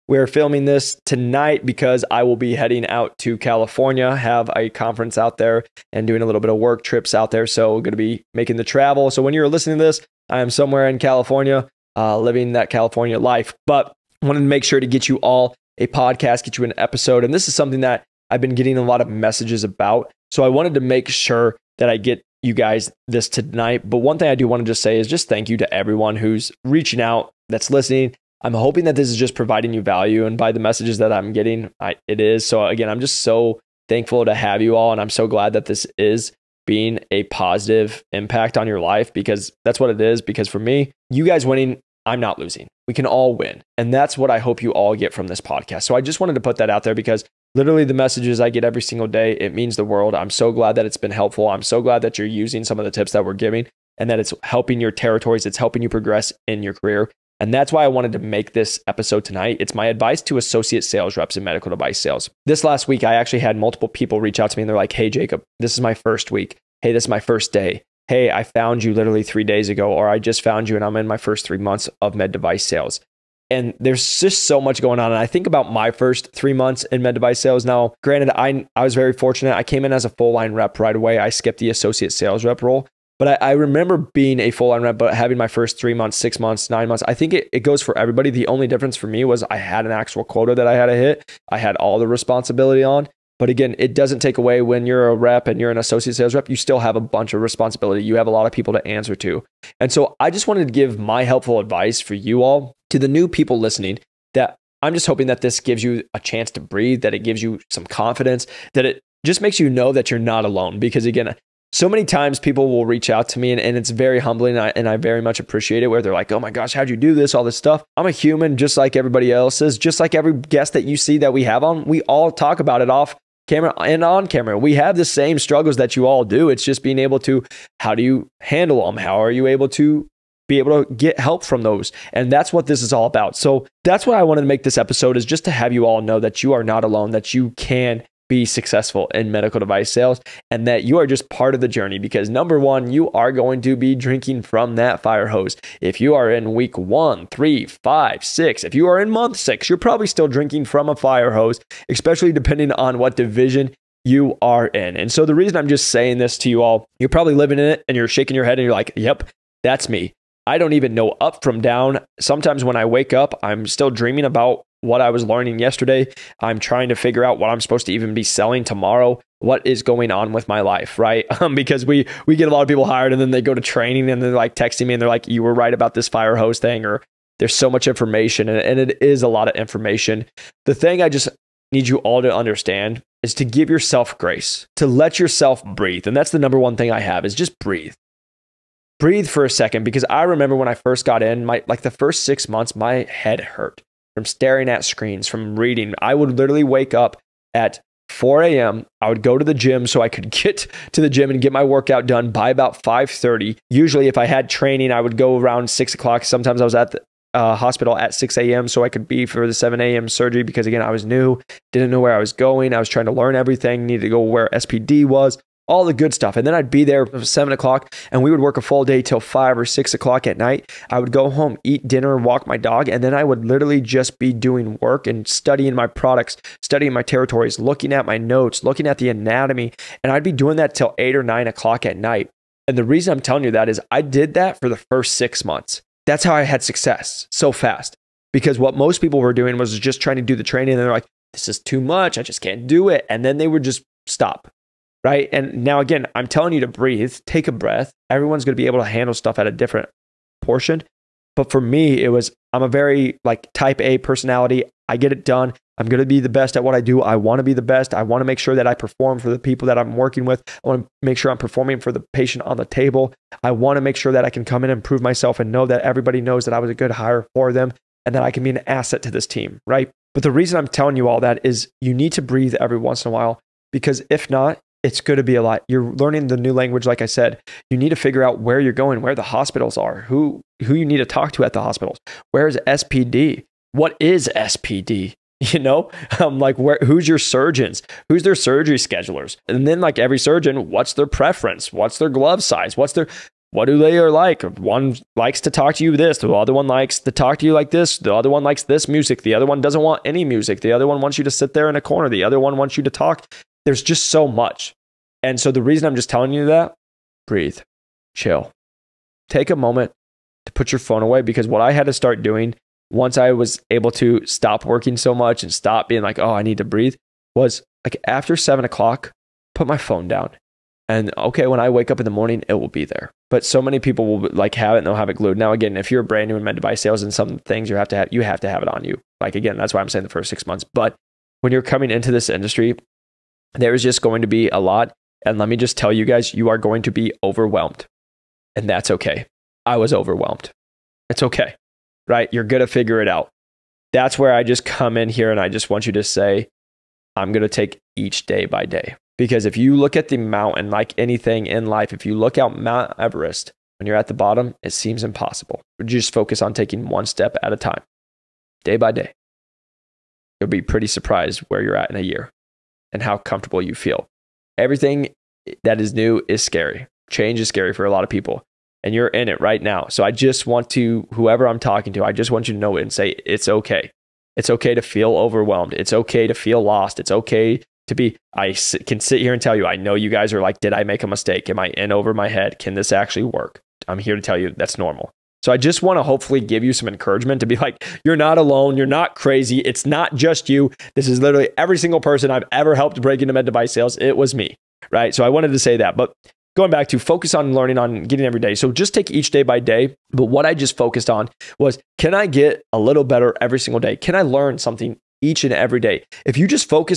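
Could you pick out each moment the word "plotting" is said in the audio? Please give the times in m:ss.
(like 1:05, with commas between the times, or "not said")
not said.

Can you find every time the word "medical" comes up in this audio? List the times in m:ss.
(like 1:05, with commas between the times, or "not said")
1:01, 2:19.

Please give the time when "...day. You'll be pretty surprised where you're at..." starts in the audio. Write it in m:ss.
5:58.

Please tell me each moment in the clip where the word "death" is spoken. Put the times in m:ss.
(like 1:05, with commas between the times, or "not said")
not said.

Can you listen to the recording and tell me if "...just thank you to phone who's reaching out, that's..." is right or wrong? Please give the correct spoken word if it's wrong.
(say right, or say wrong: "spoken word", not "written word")
wrong: "everyone", not "phone".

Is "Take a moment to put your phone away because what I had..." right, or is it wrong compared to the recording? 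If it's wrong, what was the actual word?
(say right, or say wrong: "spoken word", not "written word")
right.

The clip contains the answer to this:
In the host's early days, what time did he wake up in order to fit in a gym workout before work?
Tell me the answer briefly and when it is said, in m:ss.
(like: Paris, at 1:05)
4 a.m., at 3:18.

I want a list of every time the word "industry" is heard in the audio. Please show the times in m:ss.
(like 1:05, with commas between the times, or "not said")
5:32.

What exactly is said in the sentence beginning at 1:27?
I think it, it goes for everybody.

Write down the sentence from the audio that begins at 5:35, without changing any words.
And let me just tell you guys, you are going to be overwhelmed.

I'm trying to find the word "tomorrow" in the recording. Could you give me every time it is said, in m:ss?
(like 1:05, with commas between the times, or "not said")
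2:48.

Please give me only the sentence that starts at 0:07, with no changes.
So, we're going to be making the travel.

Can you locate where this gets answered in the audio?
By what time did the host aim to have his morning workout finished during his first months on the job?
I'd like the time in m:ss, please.
3:22.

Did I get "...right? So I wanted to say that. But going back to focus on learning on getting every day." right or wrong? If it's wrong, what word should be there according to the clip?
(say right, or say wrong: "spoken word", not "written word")
right.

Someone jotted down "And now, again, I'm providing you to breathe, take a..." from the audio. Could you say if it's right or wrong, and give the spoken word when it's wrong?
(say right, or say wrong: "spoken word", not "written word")
wrong: "telling", not "providing".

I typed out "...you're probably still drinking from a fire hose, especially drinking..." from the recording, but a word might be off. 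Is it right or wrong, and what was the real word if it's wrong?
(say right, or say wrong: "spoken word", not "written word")
wrong: "depending", not "drinking".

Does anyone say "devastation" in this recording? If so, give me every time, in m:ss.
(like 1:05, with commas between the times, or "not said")
not said.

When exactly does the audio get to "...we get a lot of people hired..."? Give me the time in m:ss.
2:52.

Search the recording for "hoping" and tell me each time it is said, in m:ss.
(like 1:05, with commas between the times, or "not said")
0:28, 1:45.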